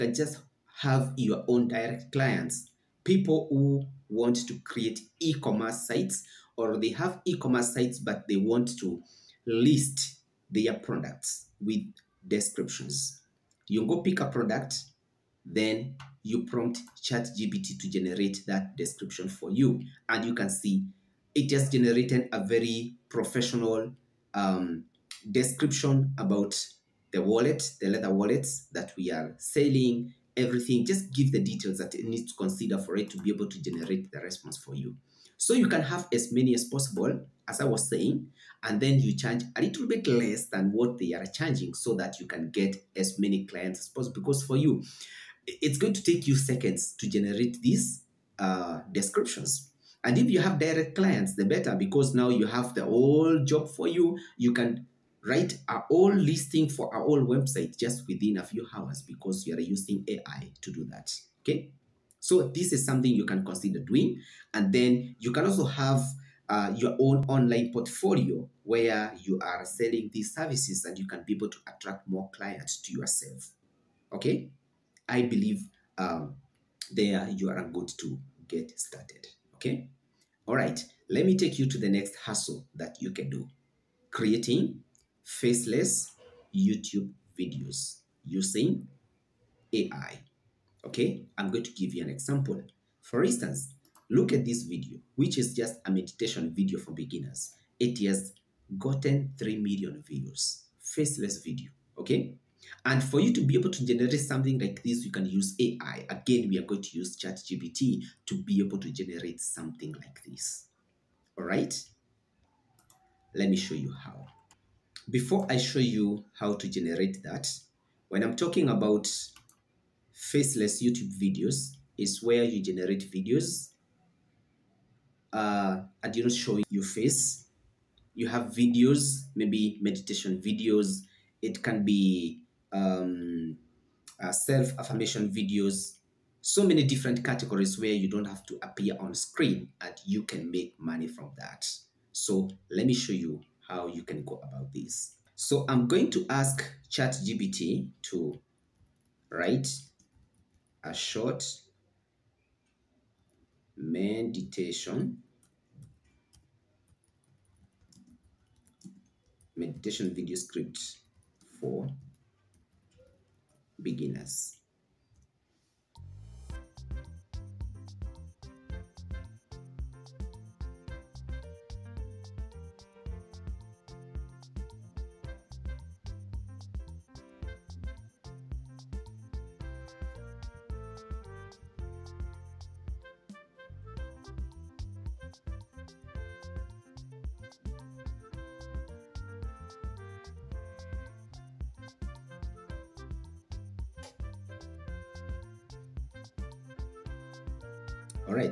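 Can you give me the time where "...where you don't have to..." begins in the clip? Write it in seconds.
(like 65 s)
137 s.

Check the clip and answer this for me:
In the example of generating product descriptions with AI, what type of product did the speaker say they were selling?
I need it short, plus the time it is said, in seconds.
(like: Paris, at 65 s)
Leather wallets, at 27 s.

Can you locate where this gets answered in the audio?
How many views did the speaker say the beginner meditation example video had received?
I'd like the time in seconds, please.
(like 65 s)
99 s.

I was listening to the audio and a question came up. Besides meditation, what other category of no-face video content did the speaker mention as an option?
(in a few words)
Self-affirmation videos.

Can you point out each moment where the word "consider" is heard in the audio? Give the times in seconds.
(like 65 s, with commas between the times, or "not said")
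32 s, 63 s.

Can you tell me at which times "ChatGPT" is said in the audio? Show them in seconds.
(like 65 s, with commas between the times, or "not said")
17 s, 107 s, 146 s.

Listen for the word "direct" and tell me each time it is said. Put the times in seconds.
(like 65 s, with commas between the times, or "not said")
1 s, 50 s.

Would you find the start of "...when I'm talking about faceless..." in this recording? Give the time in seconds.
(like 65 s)
118 s.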